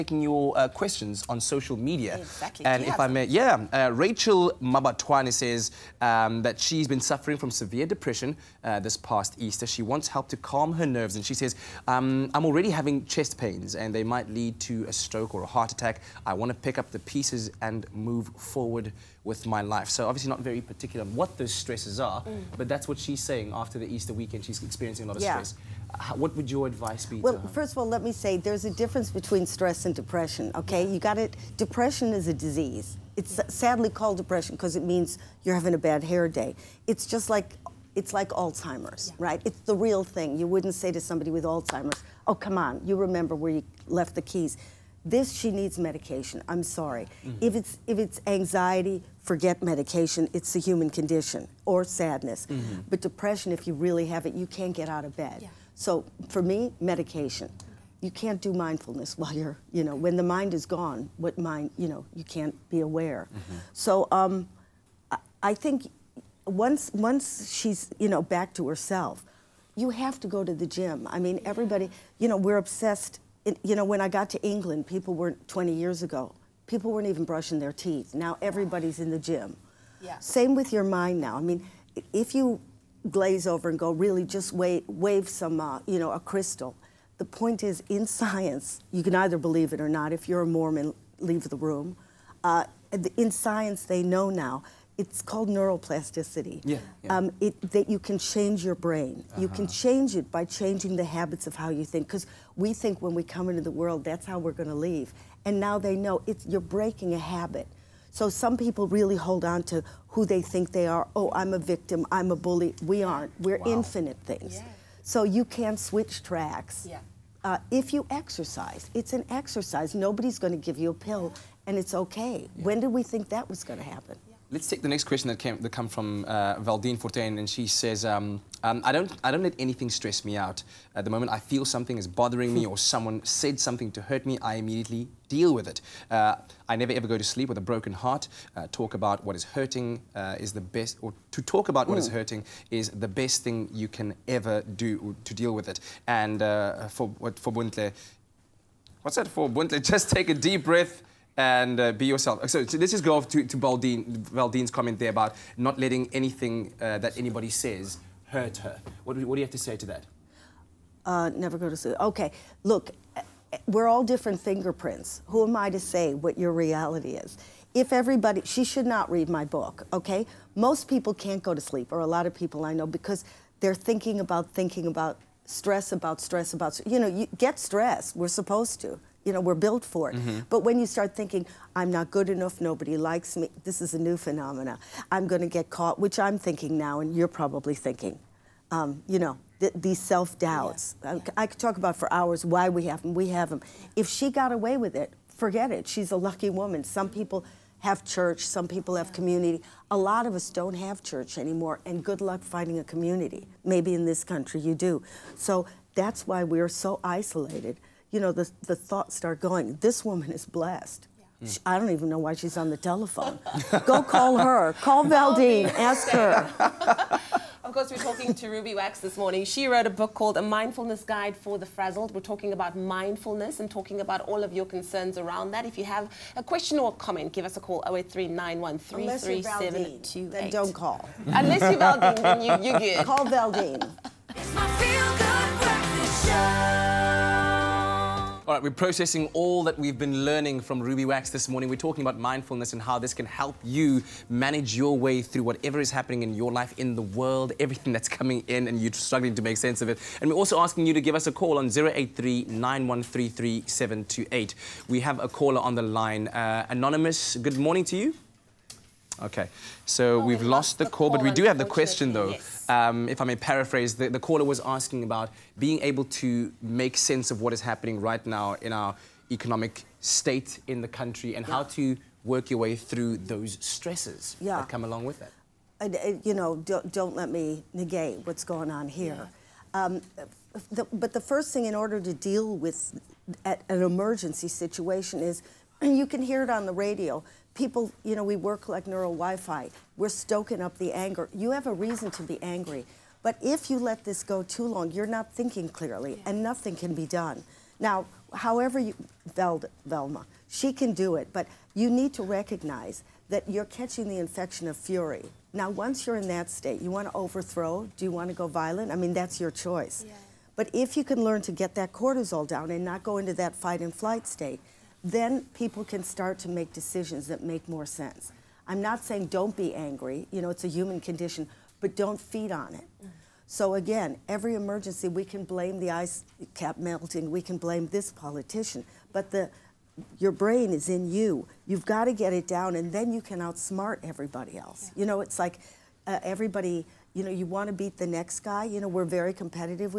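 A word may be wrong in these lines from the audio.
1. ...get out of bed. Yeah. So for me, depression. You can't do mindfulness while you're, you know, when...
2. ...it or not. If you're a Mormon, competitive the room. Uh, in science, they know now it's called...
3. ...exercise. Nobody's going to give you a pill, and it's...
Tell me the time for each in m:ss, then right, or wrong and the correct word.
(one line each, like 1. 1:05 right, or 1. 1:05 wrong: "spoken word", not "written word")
1. 0:54 wrong: "medication", not "depression"
2. 1:29 wrong: "leave", not "competitive"
3. 1:59 right.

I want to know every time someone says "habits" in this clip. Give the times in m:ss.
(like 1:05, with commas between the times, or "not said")
1:41, 1:47.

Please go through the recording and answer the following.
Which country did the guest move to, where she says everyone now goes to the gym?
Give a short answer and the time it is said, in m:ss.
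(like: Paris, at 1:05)
England, at 1:14.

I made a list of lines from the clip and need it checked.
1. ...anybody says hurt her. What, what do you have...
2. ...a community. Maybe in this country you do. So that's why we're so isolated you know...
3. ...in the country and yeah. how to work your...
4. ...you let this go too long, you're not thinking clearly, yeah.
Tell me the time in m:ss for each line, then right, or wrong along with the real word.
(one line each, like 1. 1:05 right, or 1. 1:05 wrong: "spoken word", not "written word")
1. 2:37 right
2. 3:22 right
3. 4:30 right
4. 4:53 right.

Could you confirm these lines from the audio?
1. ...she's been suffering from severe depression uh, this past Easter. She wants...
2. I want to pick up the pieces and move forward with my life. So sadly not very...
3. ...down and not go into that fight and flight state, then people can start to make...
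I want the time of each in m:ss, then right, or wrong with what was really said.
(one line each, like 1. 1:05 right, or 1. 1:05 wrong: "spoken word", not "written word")
1. 0:06 right
2. 0:16 wrong: "obviously", not "sadly"
3. 5:12 right.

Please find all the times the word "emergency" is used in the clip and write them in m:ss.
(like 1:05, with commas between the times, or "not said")
4:43, 5:24.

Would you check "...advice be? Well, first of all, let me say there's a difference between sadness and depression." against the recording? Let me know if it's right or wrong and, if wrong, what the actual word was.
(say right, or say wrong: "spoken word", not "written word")
wrong: "stress", not "sadness".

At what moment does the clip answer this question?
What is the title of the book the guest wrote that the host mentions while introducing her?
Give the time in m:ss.
3:40.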